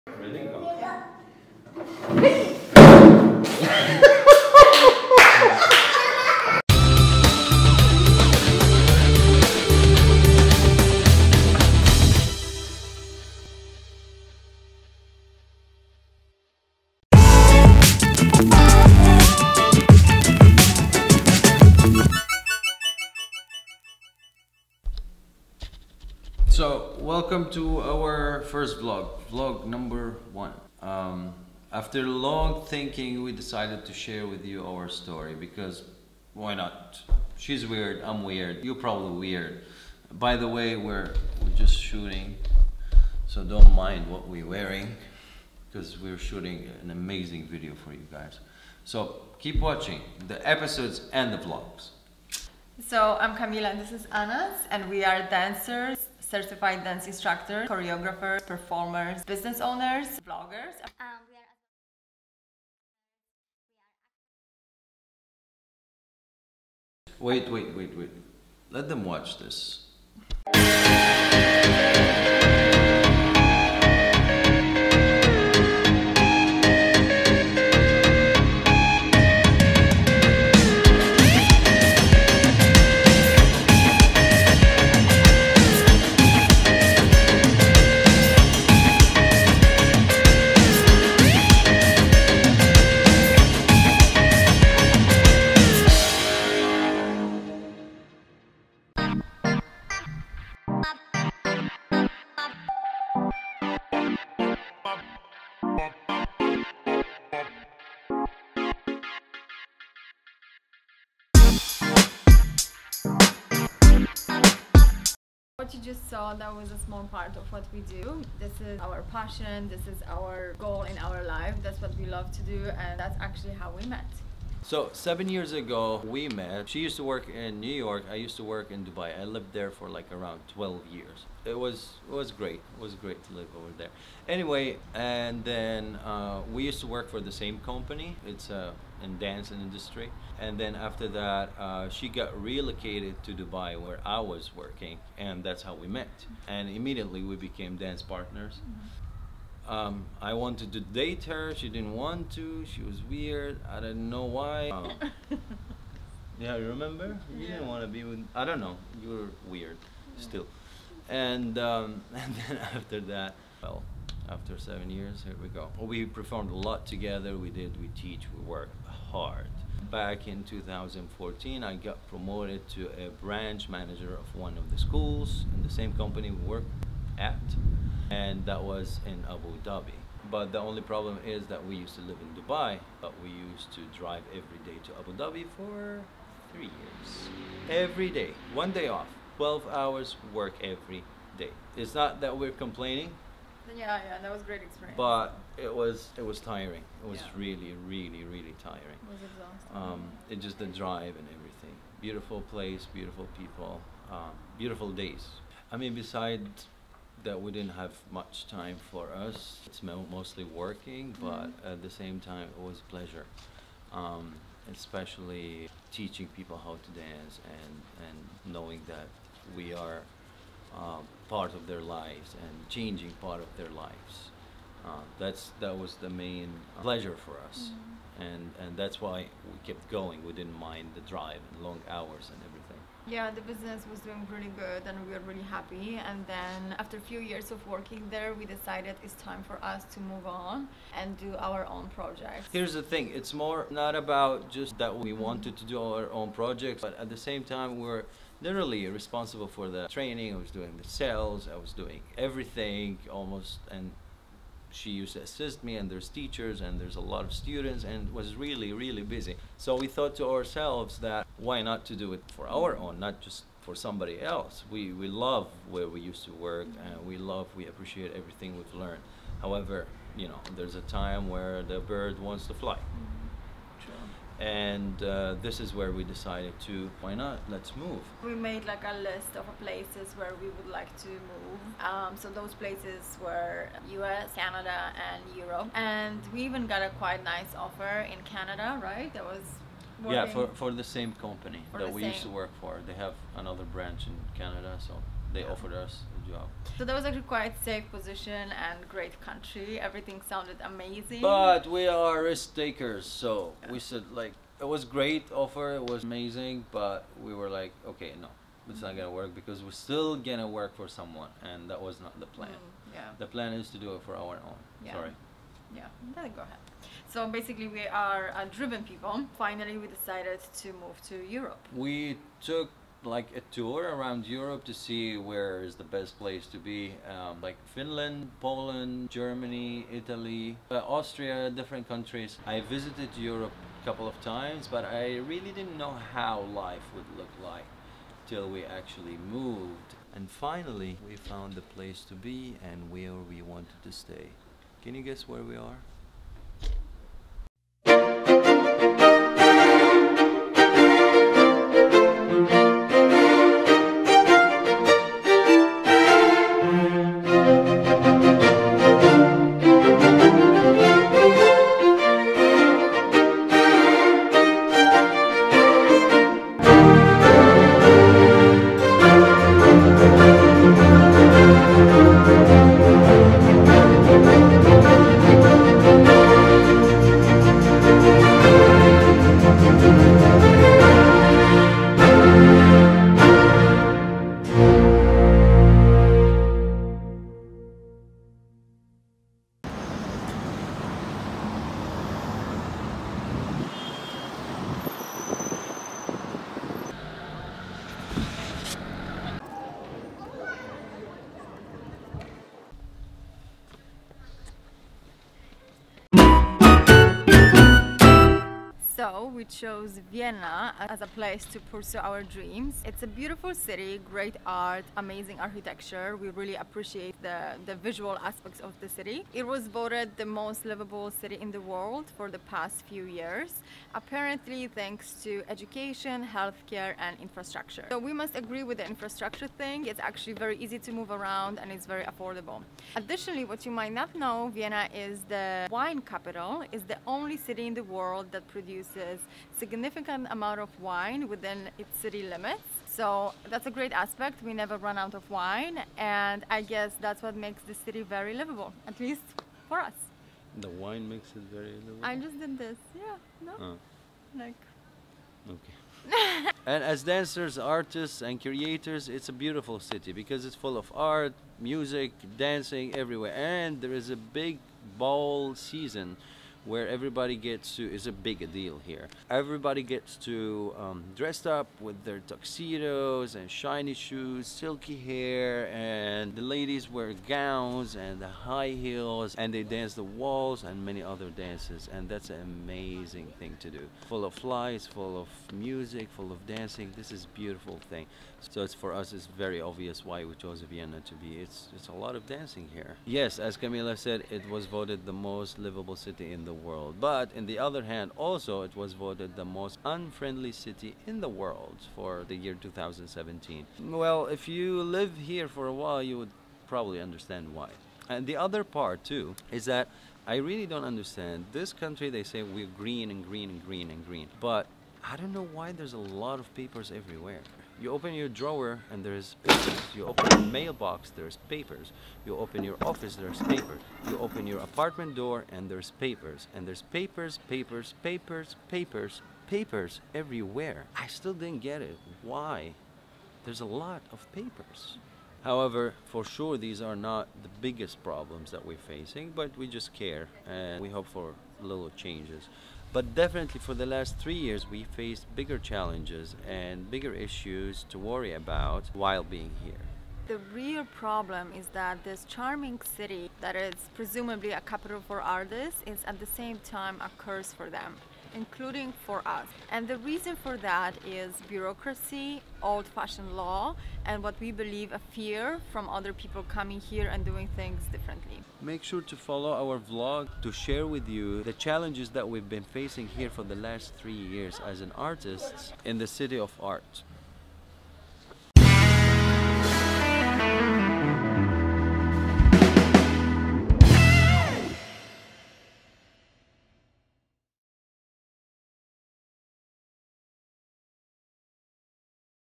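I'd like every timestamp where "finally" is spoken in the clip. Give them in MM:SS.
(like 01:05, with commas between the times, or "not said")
05:19, 05:40.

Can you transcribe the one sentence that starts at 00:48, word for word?
So keep watching the episodes and the vlogs.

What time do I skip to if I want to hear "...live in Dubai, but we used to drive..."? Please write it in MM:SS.
03:02.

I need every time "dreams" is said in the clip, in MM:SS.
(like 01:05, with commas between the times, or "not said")
06:52.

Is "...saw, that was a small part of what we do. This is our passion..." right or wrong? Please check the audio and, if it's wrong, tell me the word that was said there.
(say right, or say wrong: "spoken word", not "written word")
right.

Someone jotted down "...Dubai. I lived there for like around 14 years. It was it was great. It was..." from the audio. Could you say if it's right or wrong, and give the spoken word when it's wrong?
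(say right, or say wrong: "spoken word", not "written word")
wrong: "12", not "14".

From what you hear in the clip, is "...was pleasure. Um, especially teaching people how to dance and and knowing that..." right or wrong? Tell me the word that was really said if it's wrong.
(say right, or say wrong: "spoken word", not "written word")
right.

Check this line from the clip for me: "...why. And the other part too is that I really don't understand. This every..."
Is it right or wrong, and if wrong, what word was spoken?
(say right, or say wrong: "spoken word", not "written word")
wrong: "country", not "every".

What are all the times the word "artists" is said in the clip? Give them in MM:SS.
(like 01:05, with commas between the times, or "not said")
07:37, 09:15, 09:34.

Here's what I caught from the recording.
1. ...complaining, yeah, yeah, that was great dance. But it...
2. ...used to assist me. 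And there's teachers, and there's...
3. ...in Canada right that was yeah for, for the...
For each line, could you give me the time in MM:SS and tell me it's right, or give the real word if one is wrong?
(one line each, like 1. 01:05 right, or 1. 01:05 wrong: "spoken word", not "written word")
1. 03:12 wrong: "experience", not "dance"
2. 04:14 right
3. 04:48 right.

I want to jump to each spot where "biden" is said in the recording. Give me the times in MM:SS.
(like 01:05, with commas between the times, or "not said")
not said.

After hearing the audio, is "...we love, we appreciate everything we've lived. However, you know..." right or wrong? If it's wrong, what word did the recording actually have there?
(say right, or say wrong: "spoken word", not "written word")
wrong: "learned", not "lived".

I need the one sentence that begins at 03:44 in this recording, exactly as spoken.
Uh, that's that was the main pleasure for us, mm-hmm.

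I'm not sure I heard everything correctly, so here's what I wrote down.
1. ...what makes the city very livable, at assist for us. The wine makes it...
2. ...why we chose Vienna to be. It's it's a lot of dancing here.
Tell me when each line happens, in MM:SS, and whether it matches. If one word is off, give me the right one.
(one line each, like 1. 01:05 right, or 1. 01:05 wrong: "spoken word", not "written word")
1. 07:27 wrong: "least", not "assist"
2. 08:10 right.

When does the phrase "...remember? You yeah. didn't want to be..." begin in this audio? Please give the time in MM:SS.
02:36.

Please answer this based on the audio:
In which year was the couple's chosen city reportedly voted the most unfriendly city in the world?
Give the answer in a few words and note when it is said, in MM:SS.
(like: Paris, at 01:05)
2017, at 08:22.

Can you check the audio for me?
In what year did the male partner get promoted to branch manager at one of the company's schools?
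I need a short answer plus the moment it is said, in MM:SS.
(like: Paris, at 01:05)
2014, at 02:50.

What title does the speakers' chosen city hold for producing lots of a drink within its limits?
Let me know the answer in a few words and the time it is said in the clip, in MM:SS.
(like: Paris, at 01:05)
wine capital, at 07:15.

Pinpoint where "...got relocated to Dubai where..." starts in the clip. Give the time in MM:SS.
02:22.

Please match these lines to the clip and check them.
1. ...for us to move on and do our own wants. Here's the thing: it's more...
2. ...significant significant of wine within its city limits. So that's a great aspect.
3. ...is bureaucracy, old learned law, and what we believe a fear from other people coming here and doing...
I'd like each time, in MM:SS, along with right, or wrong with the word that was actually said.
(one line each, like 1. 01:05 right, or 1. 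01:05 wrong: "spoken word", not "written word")
1. 03:59 wrong: "projects", not "wants"
2. 07:19 wrong: "amount", not "significant"
3. 09:21 wrong: "fashioned", not "learned".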